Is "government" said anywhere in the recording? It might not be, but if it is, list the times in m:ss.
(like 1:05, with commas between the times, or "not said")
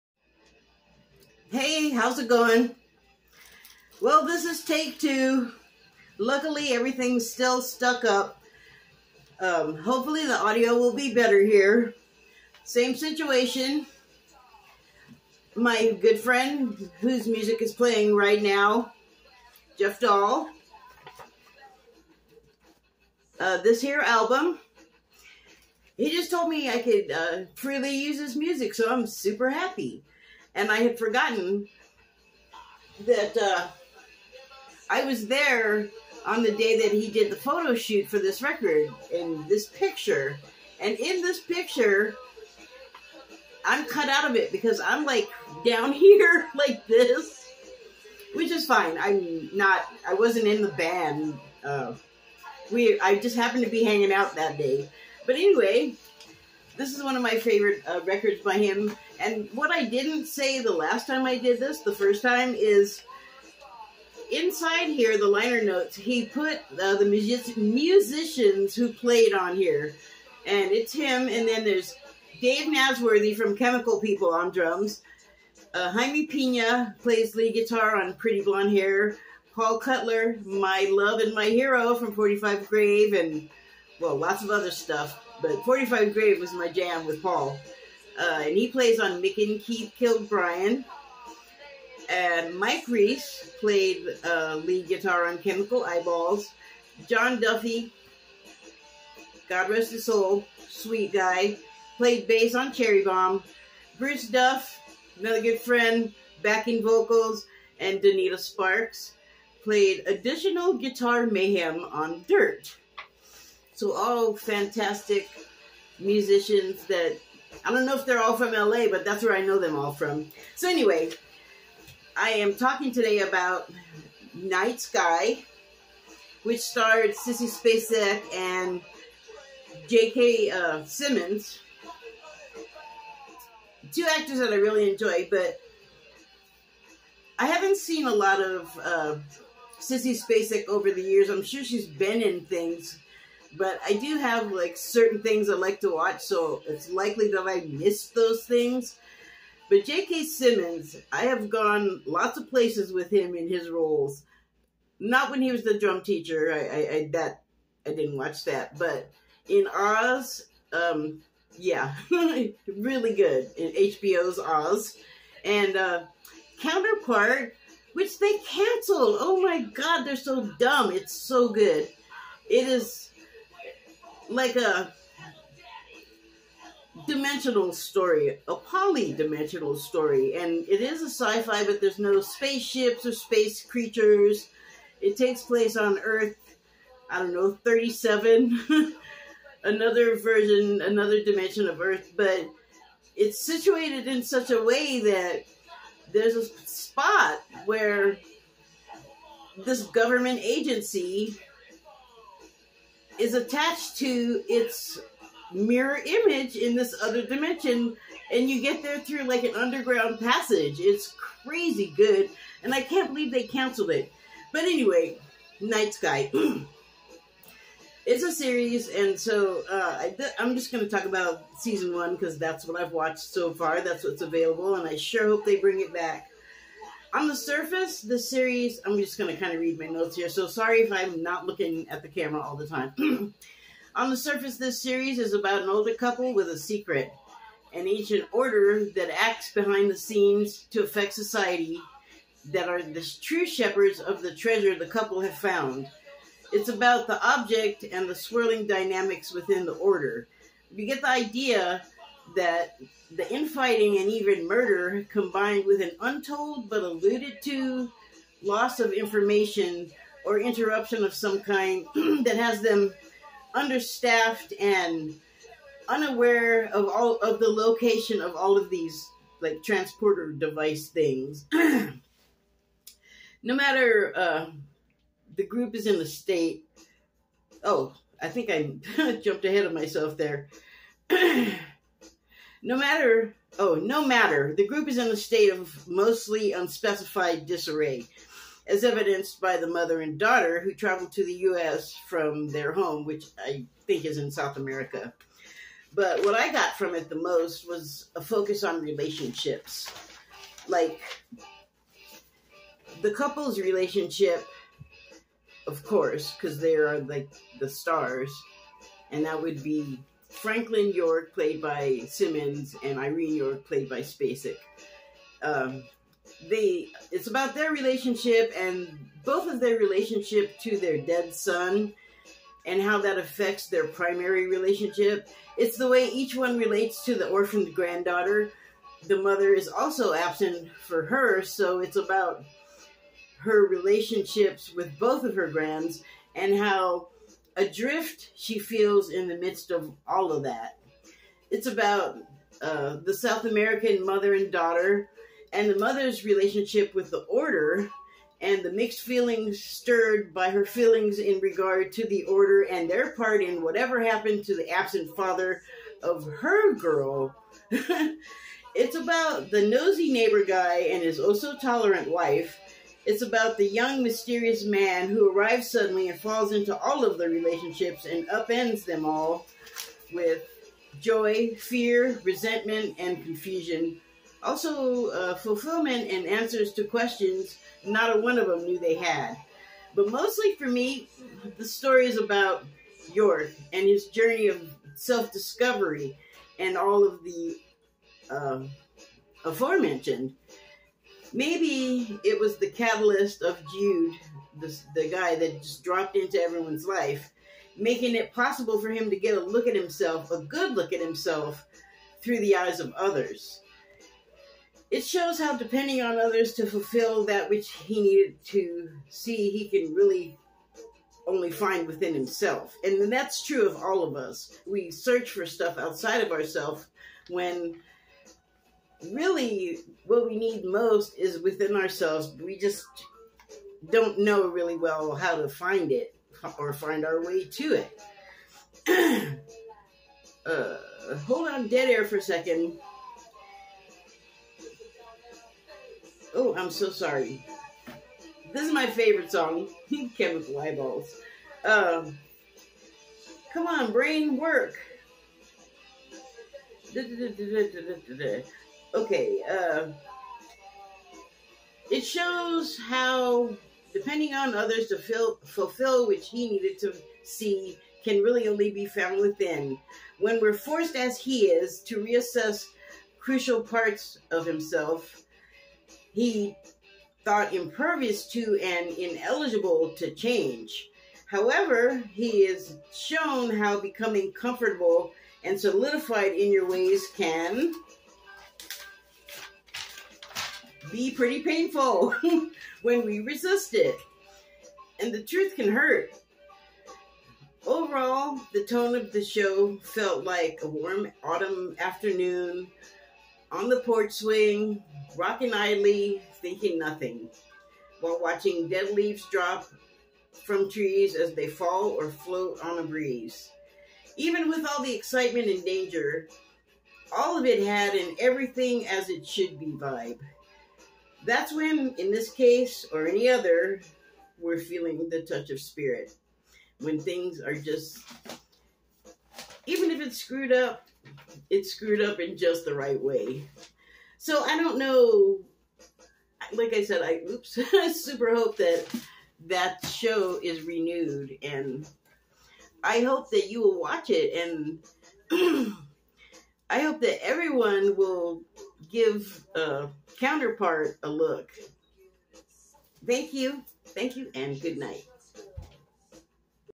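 3:19.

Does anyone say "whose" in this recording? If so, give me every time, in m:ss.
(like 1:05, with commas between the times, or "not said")
0:17.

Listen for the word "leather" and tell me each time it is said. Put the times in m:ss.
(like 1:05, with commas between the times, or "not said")
not said.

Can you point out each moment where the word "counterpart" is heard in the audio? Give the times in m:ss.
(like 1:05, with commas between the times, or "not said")
2:46, 9:00.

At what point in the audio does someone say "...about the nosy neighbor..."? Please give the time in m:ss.
5:58.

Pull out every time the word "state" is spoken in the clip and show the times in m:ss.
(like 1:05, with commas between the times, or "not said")
4:36, 4:45.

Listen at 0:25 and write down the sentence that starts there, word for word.
He just told me I could uh, freely use his music, so I'm super happy.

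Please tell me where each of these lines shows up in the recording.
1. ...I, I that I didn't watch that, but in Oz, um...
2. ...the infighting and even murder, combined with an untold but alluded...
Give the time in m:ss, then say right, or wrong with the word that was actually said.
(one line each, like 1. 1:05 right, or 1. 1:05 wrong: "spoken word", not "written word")
1. 2:36 right
2. 4:13 right.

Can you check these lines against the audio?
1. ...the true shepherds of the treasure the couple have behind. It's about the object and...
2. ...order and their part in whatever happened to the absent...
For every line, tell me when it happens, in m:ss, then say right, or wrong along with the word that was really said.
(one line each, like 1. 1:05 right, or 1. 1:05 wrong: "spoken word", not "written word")
1. 4:02 wrong: "found", not "behind"
2. 5:52 right.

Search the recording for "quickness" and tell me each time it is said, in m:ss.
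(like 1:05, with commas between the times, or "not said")
not said.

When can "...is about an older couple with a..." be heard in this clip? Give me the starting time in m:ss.
3:55.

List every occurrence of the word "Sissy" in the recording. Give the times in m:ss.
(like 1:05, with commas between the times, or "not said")
2:07, 2:19.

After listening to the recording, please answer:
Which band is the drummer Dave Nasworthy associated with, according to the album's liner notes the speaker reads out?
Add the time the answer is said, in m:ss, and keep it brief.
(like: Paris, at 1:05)
Chemical People, at 1:13.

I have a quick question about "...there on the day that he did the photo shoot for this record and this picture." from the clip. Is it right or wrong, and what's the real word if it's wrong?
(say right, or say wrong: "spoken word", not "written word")
right.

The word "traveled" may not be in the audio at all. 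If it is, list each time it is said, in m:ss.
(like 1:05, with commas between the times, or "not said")
4:50.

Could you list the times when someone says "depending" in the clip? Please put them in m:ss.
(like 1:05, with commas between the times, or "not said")
6:45, 7:33.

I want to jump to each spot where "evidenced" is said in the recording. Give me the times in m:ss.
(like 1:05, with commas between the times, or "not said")
4:48.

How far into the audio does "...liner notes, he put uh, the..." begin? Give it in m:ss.
1:05.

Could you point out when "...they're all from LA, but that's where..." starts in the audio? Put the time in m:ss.
1:58.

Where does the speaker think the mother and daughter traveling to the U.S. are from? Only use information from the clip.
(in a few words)
South America.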